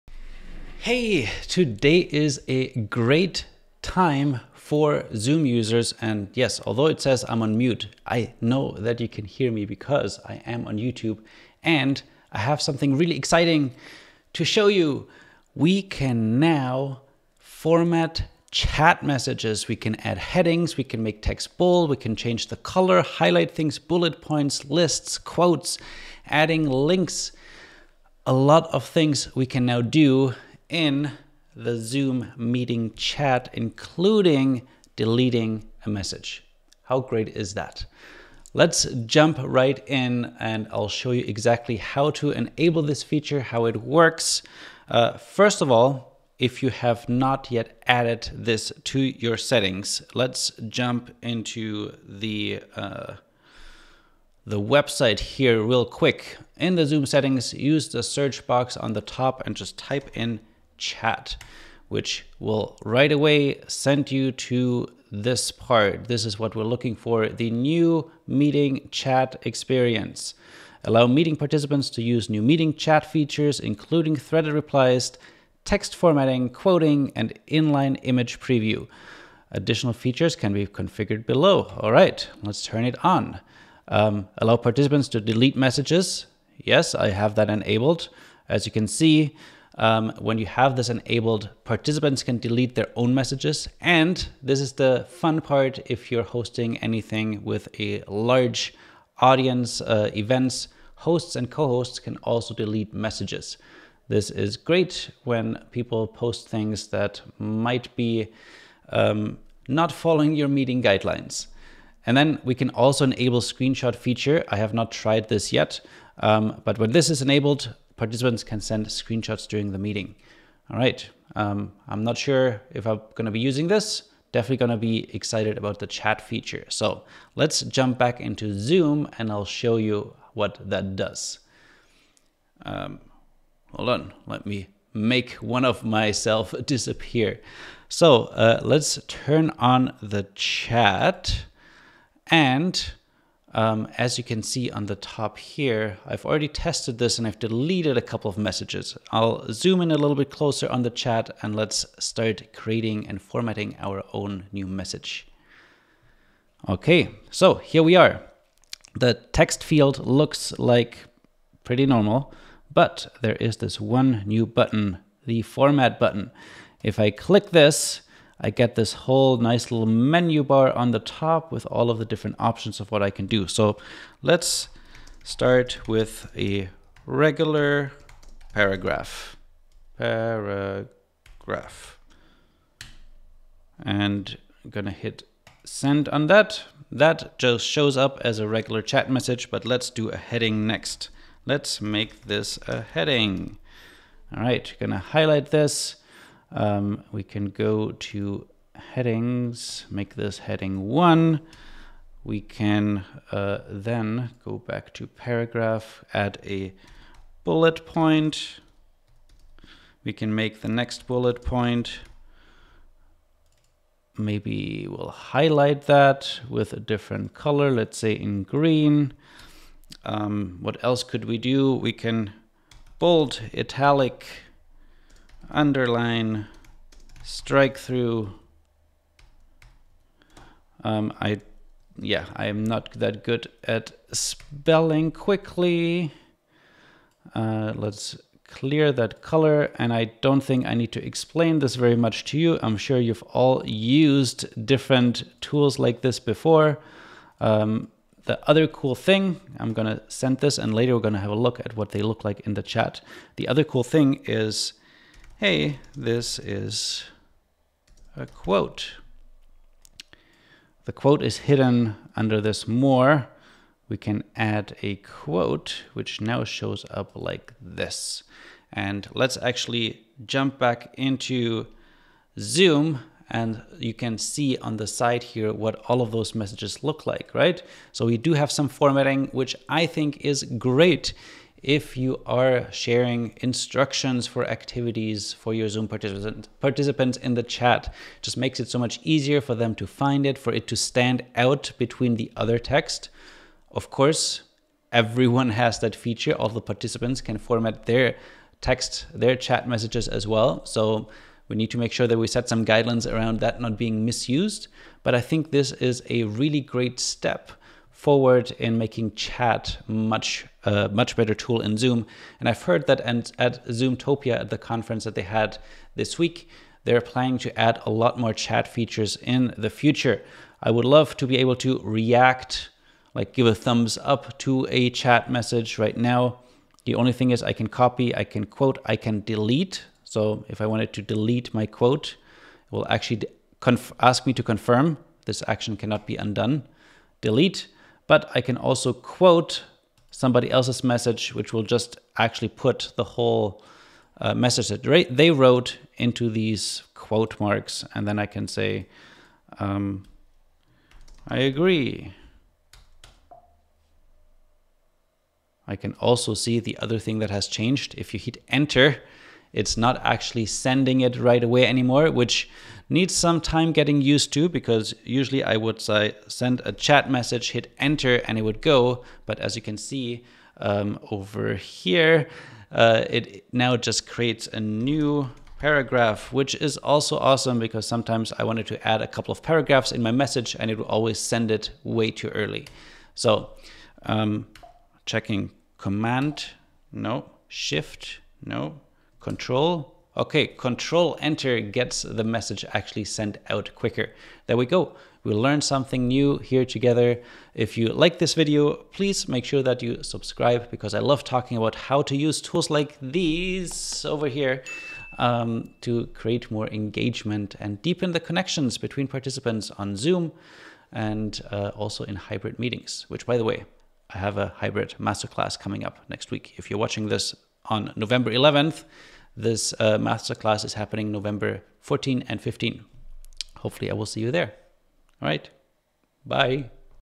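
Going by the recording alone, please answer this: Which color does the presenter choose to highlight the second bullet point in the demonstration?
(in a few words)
green.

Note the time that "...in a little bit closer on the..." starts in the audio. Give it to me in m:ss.
2:29.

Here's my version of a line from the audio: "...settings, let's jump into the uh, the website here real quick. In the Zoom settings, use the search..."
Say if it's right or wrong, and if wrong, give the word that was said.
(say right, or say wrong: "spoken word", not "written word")
right.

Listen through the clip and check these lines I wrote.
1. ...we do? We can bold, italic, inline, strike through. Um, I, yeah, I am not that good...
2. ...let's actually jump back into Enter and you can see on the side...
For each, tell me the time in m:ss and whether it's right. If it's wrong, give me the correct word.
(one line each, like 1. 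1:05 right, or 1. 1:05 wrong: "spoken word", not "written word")
1. 3:41 wrong: "underline", not "inline"
2. 4:29 wrong: "Zoom", not "Enter".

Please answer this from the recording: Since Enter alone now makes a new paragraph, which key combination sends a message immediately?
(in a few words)
Control Enter.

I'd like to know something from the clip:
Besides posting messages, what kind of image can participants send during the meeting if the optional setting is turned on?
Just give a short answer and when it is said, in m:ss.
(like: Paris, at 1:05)
screenshots, at 1:58.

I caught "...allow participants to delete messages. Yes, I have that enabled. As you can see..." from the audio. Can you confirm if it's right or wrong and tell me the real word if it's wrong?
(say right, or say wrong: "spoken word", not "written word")
right.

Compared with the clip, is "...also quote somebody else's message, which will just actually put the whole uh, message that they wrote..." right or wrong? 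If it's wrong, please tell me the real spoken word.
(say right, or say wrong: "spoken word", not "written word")
right.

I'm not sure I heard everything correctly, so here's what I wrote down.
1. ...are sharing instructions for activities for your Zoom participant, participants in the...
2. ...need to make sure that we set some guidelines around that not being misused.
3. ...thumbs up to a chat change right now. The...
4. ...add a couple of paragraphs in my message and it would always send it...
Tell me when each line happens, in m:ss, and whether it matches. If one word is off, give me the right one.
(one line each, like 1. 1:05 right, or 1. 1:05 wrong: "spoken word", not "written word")
1. 4:42 right
2. 5:01 right
3. 5:23 wrong: "message", not "change"
4. 6:18 right.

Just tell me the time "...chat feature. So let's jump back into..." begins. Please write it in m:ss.
2:05.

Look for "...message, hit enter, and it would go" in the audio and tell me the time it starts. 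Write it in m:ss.
6:07.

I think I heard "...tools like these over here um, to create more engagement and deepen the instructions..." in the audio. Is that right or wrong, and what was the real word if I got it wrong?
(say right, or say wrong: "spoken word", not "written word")
wrong: "connections", not "instructions".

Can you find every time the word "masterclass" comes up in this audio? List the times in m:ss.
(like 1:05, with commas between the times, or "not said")
6:54, 6:59.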